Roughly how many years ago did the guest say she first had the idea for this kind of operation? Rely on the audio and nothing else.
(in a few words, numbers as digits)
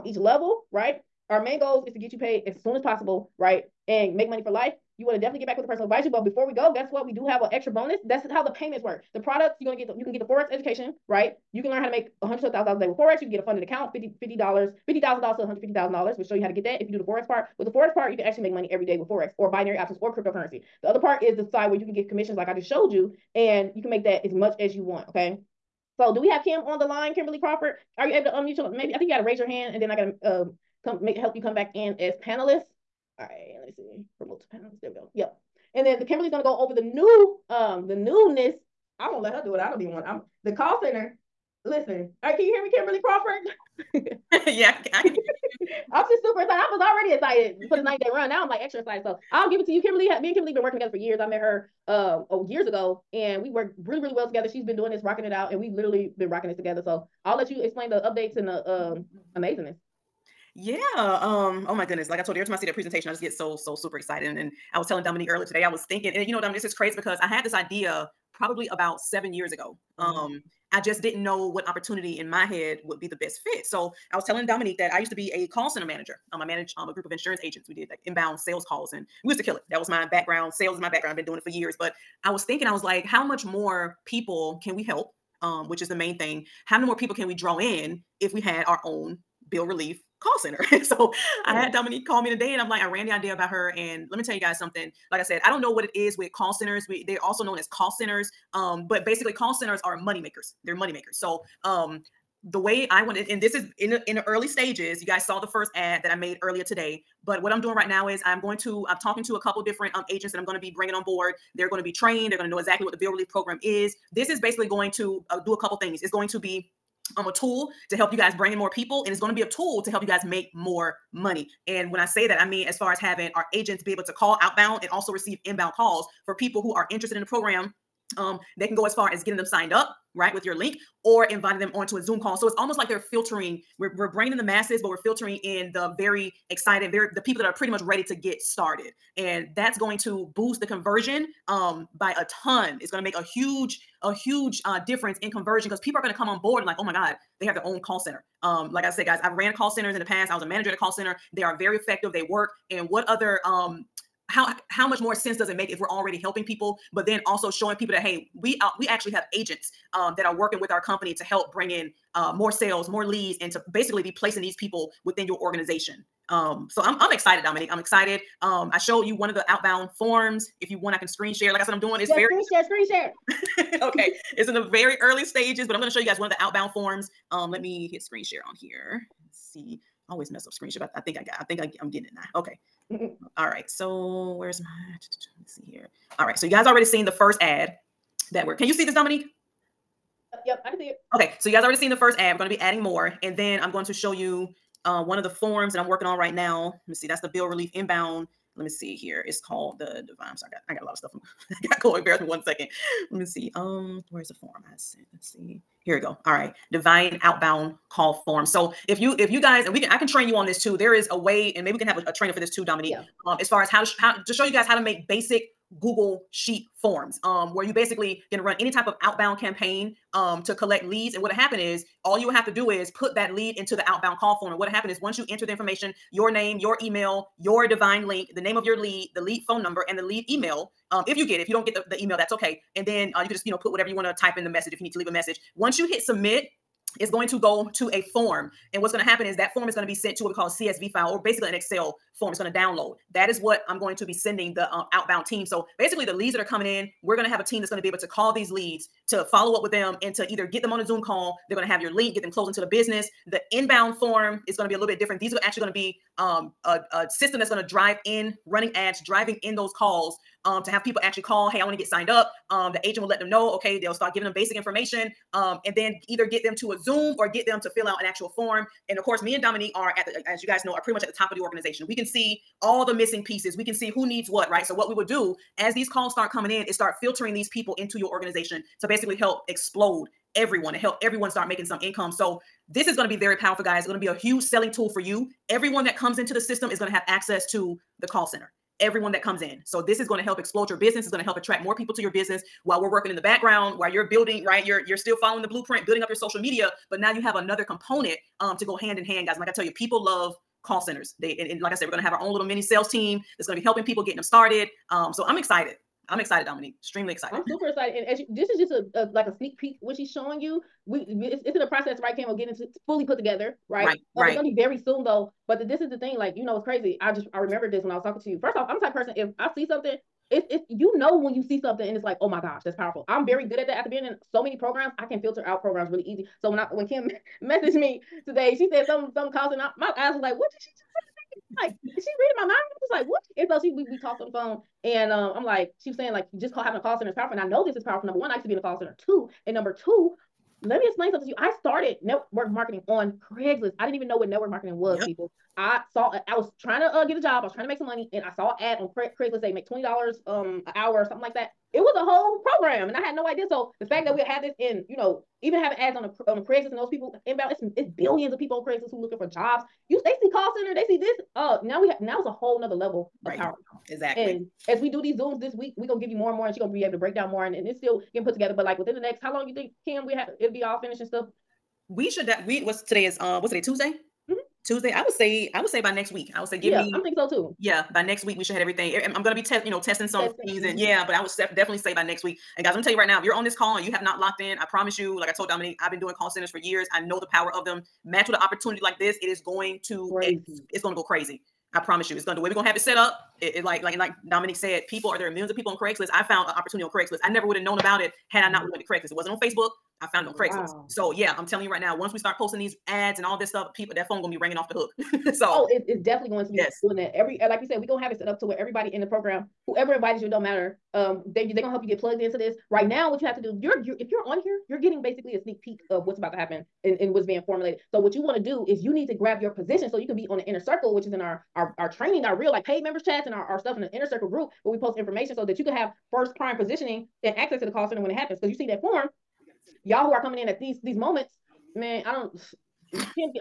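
7.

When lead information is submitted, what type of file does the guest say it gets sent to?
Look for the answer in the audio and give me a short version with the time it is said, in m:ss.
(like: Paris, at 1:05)
CSV file, at 4:00.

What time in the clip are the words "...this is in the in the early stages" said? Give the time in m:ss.
1:43.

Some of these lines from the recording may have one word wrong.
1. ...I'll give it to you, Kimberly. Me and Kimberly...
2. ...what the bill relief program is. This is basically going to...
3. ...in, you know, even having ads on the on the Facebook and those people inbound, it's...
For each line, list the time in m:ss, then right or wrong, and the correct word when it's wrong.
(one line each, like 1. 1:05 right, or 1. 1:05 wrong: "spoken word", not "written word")
1. 0:49 right
2. 1:52 right
3. 5:54 wrong: "Craigslist", not "Facebook".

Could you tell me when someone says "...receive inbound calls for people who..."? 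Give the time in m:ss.
2:05.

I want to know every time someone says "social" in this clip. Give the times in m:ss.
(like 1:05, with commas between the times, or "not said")
4:56.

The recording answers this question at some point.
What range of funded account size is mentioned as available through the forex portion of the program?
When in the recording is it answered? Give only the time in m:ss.
0:14.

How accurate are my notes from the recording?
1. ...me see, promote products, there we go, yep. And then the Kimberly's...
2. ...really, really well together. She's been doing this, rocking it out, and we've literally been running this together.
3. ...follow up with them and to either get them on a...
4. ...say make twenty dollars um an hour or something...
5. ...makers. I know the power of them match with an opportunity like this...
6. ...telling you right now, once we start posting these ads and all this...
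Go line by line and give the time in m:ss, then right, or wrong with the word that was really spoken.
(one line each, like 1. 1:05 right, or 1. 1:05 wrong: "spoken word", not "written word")
1. 0:33 wrong: "panelists", not "products"
2. 0:53 wrong: "rocking", not "running"
3. 4:09 right
4. 5:49 right
5. 6:26 wrong: "years", not "makers"
6. 6:41 right.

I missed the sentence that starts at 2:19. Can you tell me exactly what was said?
And that's going to boost the conversion um, by a ton.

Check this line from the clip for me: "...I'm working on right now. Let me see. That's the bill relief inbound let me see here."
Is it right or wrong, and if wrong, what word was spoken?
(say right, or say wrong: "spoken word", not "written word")
right.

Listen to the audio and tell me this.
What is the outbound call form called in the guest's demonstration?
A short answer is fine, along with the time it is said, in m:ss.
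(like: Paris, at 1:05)
Divine Outbound call form, at 3:26.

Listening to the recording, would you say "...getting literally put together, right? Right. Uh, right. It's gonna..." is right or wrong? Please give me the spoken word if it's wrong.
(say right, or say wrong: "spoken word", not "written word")
wrong: "fully", not "literally".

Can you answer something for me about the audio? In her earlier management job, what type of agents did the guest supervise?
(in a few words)
insurance agents.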